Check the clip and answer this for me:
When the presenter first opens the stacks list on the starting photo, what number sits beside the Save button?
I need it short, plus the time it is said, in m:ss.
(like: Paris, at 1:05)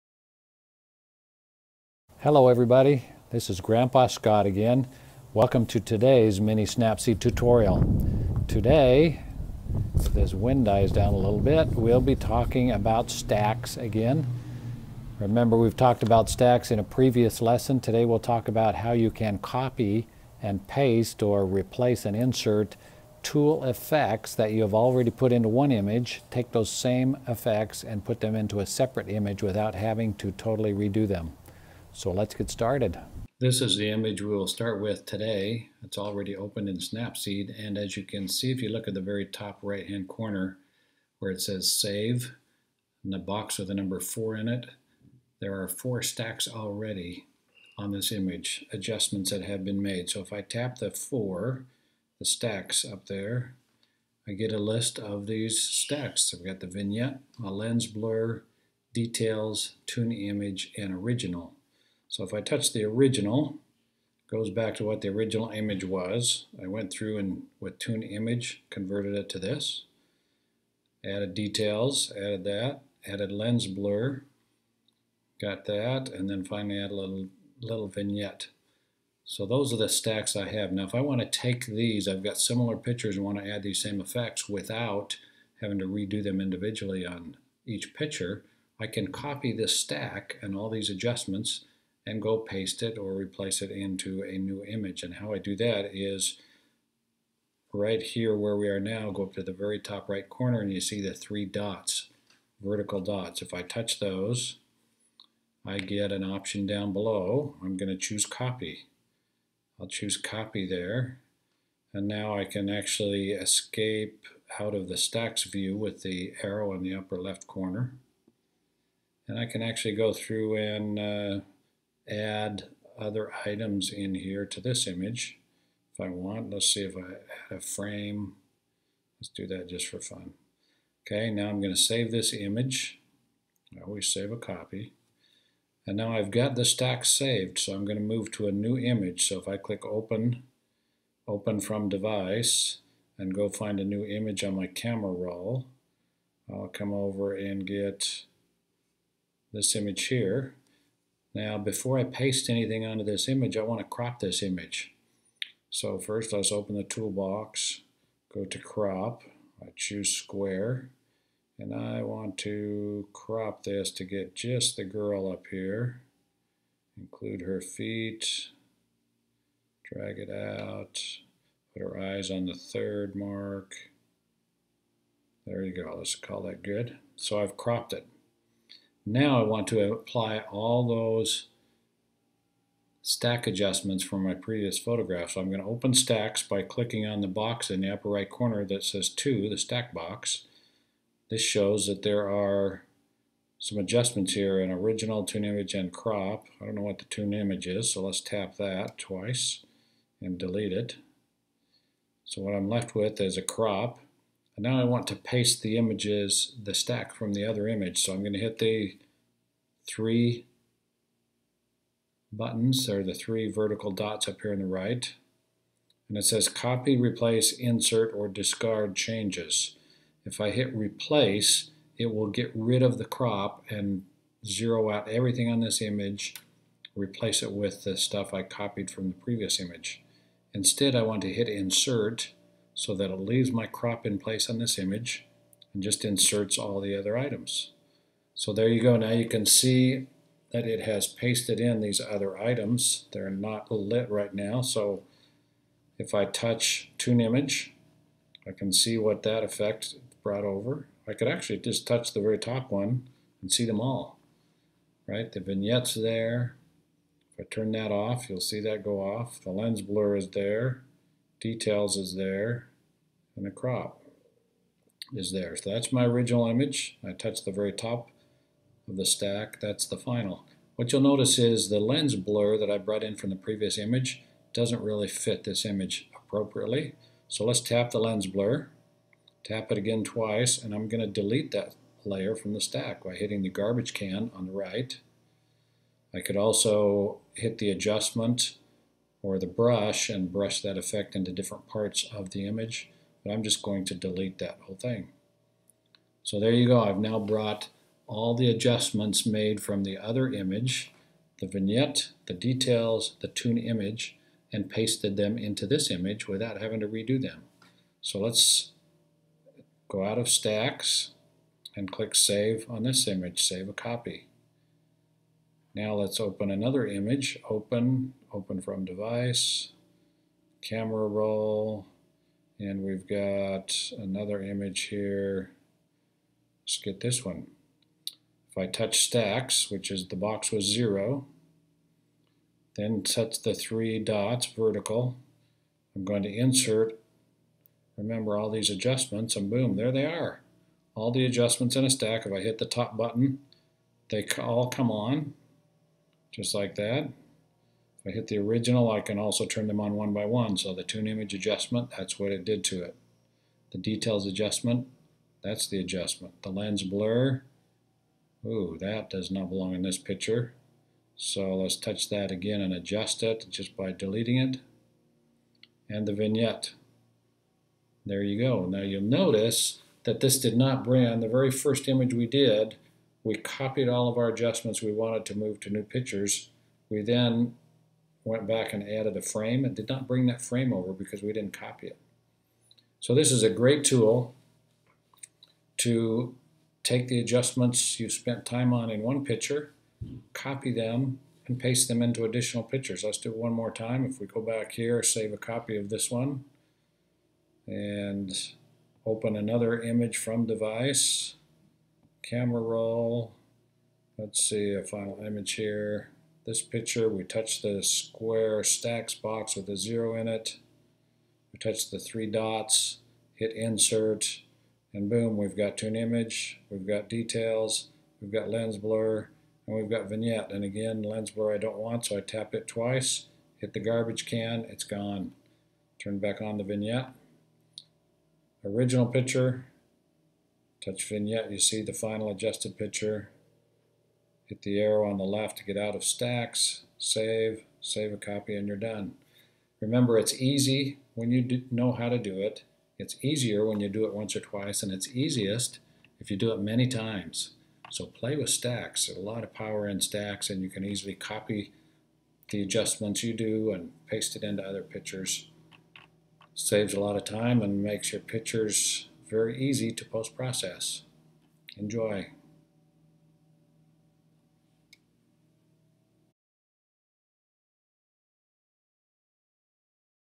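4, at 0:43.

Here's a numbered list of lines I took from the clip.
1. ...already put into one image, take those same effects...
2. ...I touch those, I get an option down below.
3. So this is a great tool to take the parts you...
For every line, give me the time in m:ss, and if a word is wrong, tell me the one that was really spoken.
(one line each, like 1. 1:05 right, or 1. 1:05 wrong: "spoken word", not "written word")
1. 0:24 right
2. 1:43 right
3. 6:22 wrong: "adjustments", not "parts".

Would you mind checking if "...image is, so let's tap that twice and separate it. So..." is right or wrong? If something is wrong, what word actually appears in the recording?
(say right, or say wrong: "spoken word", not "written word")
wrong: "delete", not "separate".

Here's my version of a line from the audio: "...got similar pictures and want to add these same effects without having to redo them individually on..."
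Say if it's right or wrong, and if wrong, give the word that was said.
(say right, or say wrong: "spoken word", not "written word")
right.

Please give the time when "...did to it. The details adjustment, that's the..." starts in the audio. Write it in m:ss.
5:52.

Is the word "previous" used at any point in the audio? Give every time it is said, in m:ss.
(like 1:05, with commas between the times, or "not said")
0:16, 3:04, 3:49, 4:33.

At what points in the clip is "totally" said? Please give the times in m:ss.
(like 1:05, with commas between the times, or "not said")
0:30.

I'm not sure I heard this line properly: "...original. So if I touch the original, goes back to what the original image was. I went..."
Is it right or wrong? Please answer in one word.
right.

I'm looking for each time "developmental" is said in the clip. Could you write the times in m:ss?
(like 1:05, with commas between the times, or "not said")
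not said.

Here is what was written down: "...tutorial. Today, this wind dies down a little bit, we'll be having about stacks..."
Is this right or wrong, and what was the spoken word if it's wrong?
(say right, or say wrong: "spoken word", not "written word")
wrong: "talking", not "having".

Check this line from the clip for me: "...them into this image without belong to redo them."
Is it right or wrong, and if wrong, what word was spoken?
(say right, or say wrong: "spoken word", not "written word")
wrong: "having", not "belong".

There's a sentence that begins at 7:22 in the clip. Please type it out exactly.
It's easier when you do it once or twice, and it's easiest if you do it many times.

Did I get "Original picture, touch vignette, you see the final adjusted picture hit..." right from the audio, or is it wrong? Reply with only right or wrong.
right.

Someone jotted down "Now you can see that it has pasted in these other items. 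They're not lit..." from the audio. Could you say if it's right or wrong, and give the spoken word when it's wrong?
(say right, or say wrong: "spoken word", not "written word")
right.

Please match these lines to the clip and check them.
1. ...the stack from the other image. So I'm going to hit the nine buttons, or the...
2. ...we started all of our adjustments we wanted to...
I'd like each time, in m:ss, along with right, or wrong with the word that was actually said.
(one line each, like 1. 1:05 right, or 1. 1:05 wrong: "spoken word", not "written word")
1. 3:26 wrong: "three", not "nine"
2. 6:13 wrong: "copied", not "started".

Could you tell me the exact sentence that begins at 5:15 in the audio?
Now let's open another image, open open from device, camera roll, and we've got another image here.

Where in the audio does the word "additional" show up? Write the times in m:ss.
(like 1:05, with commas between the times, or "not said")
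6:32.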